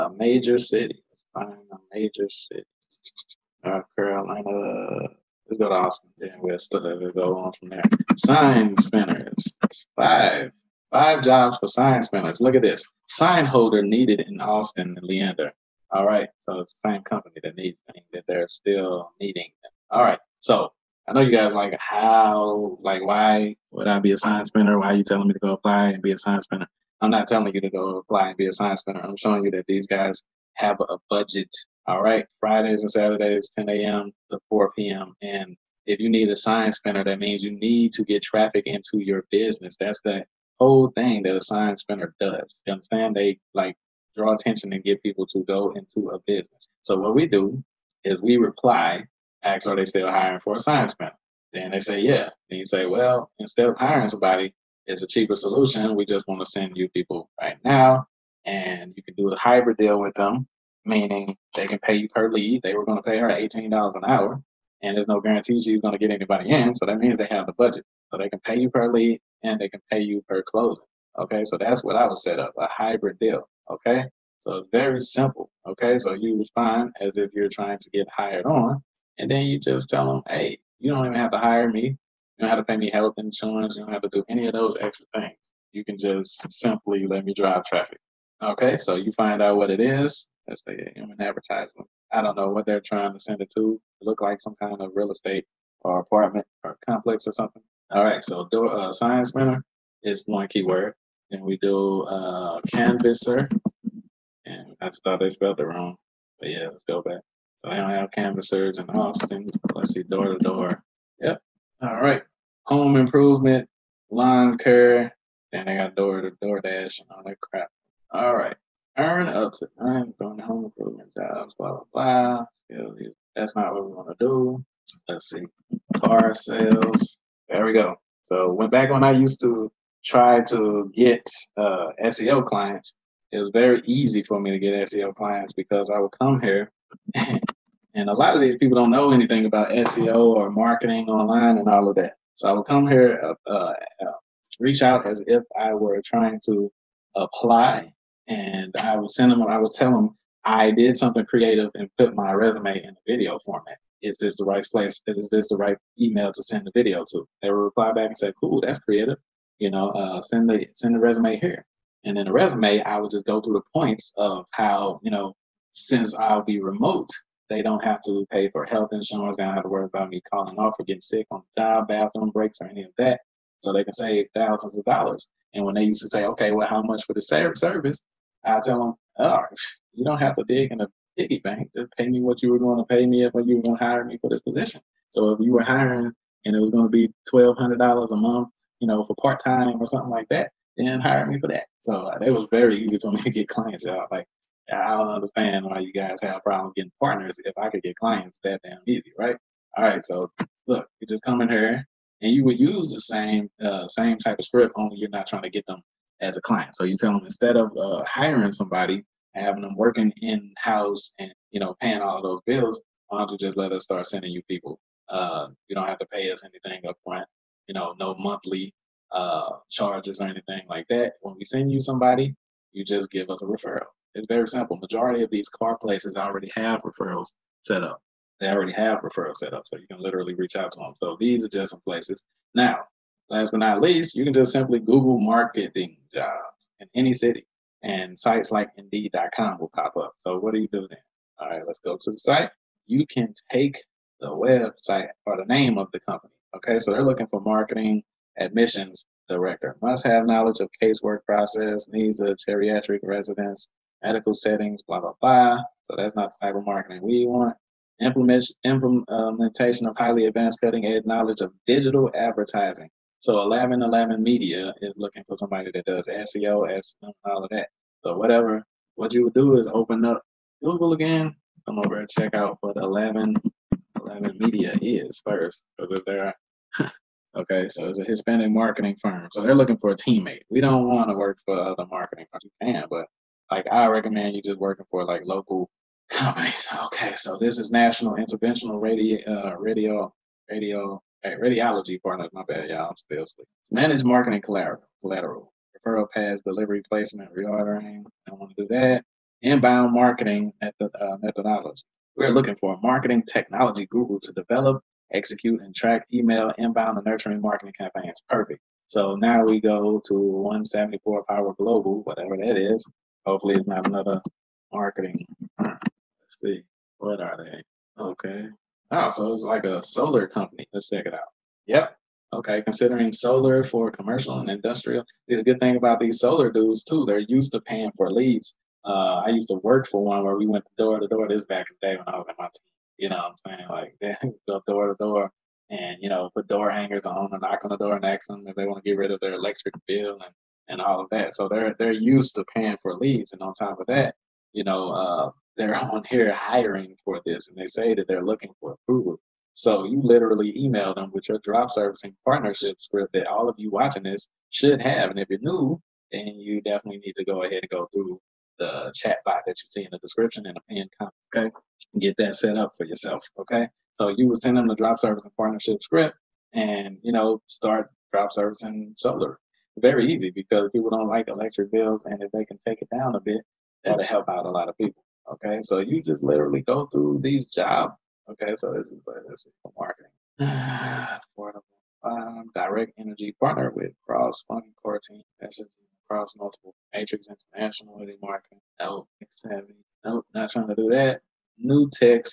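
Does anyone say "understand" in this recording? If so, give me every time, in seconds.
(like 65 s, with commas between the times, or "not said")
42 s, 195 s.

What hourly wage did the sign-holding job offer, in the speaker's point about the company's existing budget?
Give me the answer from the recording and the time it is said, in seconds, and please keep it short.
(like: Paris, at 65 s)
$18, at 63 s.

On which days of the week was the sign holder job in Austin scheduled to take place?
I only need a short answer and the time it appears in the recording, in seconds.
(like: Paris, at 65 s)
Fridays and Saturdays, at 32 s.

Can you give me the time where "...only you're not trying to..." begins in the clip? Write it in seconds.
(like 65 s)
204 s.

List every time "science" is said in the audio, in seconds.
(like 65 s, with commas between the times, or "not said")
36 s, 41 s, 50 s, 98 s.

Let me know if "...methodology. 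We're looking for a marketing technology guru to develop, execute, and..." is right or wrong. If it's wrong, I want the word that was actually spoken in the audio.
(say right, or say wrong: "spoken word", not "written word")
right.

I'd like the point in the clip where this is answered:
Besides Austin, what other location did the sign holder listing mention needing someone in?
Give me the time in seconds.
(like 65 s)
15 s.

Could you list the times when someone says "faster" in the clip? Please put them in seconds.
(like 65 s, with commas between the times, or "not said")
not said.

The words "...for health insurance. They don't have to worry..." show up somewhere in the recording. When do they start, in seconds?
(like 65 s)
168 s.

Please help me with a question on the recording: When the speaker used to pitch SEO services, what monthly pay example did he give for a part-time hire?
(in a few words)
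$1,200.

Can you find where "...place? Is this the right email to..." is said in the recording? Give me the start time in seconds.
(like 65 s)
154 s.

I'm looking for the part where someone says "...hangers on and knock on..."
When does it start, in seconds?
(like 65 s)
336 s.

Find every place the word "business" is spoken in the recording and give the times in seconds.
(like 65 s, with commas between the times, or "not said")
39 s, 46 s.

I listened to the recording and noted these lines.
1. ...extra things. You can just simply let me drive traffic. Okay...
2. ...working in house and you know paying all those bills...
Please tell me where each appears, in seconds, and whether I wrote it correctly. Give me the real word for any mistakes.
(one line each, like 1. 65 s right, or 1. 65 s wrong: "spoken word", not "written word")
1. 84 s right
2. 209 s right.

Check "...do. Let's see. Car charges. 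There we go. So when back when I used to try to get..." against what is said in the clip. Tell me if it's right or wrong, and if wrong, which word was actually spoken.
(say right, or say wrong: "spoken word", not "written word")
wrong: "sales", not "charges".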